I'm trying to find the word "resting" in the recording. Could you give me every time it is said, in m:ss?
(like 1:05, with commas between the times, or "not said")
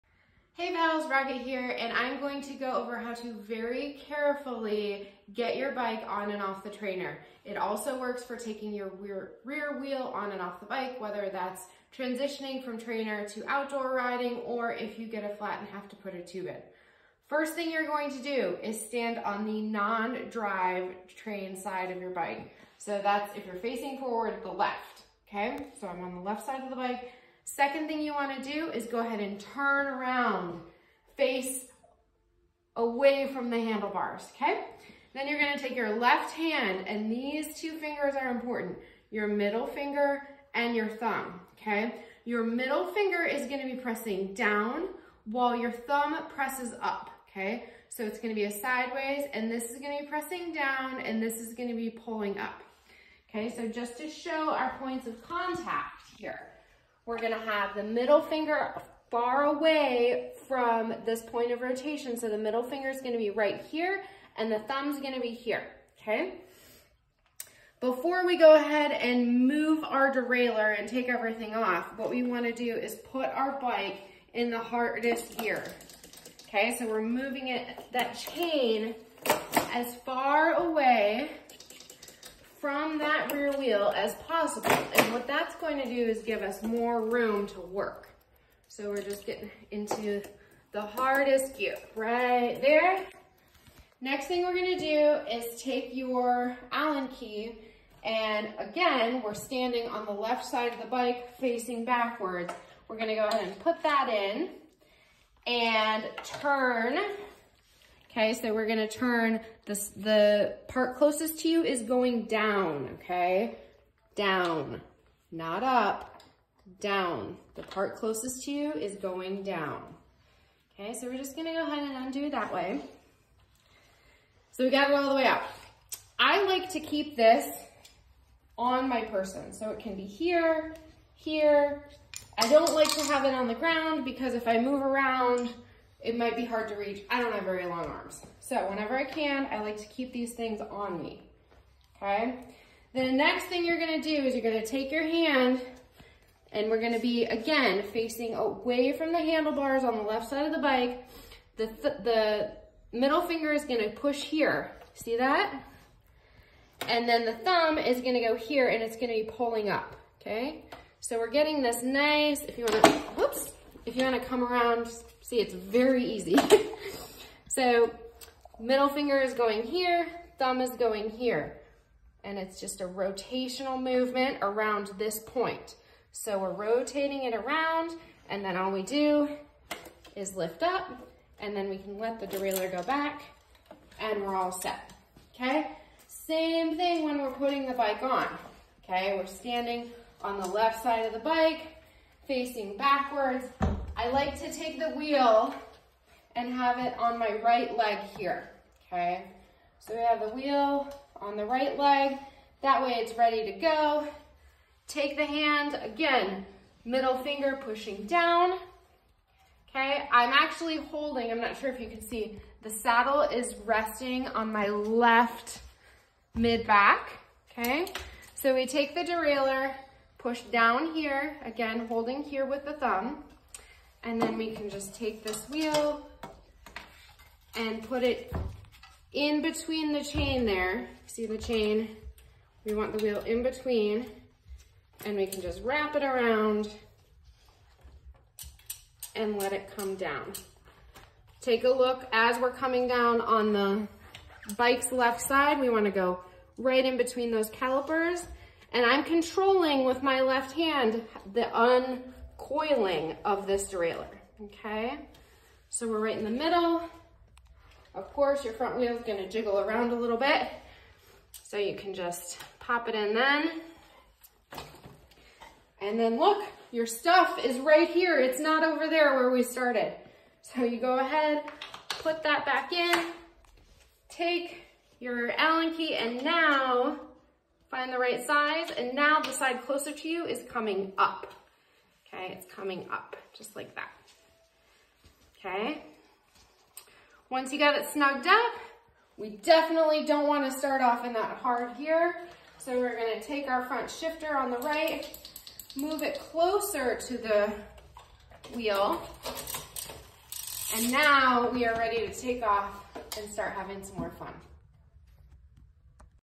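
3:33.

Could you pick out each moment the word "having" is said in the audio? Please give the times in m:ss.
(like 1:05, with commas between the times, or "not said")
5:03.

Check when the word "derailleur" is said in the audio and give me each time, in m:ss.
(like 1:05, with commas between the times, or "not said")
1:10, 3:02, 3:39, 4:13.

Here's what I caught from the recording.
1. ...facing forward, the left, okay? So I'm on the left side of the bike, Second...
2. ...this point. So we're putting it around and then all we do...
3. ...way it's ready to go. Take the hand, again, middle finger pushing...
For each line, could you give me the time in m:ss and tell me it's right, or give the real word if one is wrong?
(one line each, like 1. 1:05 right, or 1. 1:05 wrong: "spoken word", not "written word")
1. 0:23 right
2. 2:54 wrong: "rotating", not "putting"
3. 3:22 right.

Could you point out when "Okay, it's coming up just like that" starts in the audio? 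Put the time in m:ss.
4:42.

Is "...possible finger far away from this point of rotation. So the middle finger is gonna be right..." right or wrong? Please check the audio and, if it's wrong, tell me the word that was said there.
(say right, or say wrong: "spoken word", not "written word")
wrong: "middle", not "possible".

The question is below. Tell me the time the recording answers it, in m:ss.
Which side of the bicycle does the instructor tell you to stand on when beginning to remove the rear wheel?
0:19.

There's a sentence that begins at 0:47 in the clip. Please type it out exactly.
So it's gonna be a sideways, and this is gonna be pressing down, and this is gonna be pulling up.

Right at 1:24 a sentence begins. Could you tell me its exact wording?
And what that's going to do is give us more room to work.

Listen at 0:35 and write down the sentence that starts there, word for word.
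Then you're gonna take your left hand, and these two fingers are important, your middle finger and your thumb, okay?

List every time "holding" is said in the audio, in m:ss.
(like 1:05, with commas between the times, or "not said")
3:30, 3:41.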